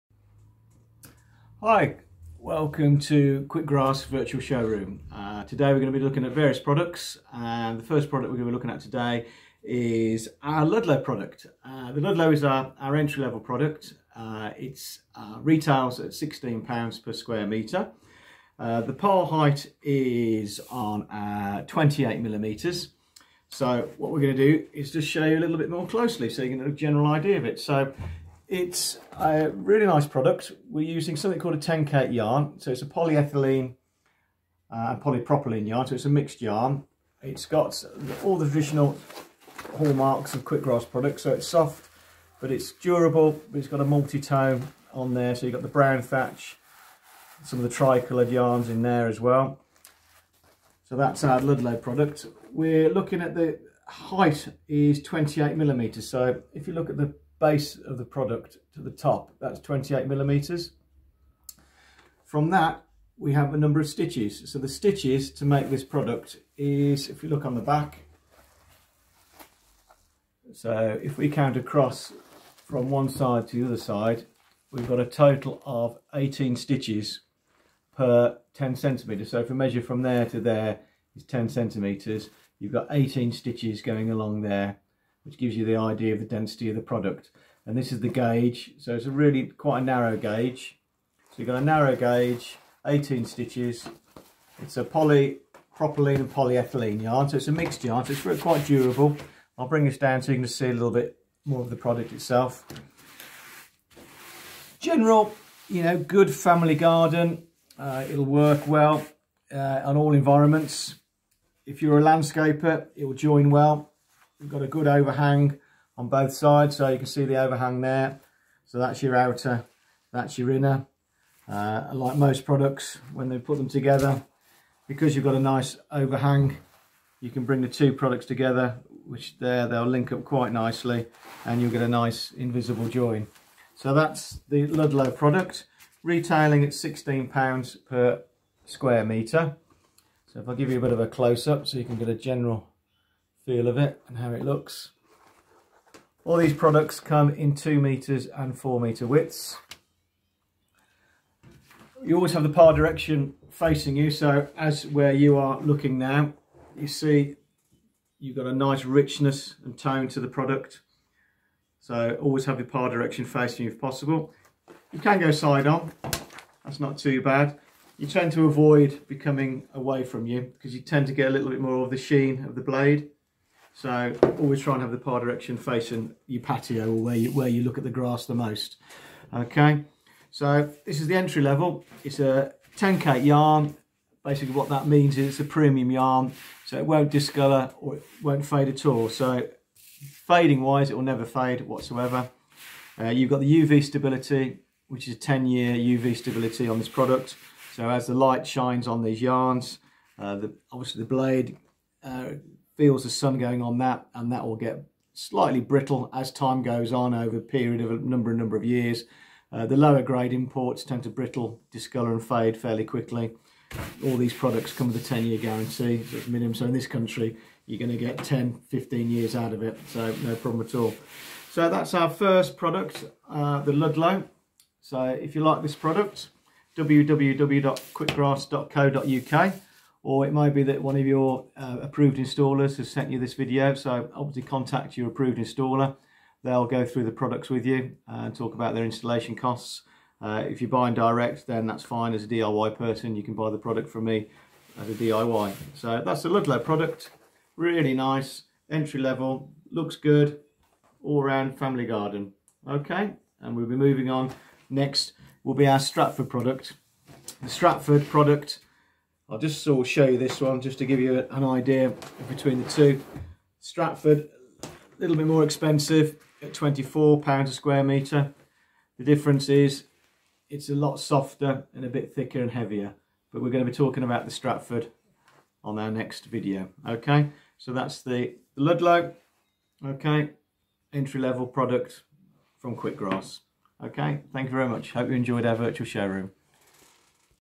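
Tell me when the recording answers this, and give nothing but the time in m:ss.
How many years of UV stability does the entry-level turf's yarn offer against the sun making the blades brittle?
3:15.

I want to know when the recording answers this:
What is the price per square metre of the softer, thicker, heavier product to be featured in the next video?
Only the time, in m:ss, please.
4:26.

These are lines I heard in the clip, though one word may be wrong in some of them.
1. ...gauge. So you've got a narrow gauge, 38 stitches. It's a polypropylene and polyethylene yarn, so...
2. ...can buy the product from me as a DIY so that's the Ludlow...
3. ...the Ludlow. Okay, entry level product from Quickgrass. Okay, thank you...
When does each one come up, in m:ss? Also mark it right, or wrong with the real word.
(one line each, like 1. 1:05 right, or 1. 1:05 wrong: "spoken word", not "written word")
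1. 1:30 wrong: "18", not "38"
2. 4:03 right
3. 4:38 right.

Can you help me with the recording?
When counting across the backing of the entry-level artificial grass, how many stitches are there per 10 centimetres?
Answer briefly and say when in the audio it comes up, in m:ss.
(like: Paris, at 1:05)
18, at 1:16.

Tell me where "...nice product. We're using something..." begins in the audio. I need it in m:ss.
0:29.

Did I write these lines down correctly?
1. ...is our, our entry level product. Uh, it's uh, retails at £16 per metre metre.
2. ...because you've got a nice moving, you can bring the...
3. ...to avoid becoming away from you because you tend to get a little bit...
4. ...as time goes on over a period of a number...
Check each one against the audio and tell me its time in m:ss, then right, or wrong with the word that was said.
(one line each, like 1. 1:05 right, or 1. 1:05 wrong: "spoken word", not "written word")
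1. 0:12 wrong: "square", not "metre"
2. 2:04 wrong: "overhang", not "moving"
3. 2:48 right
4. 3:26 right.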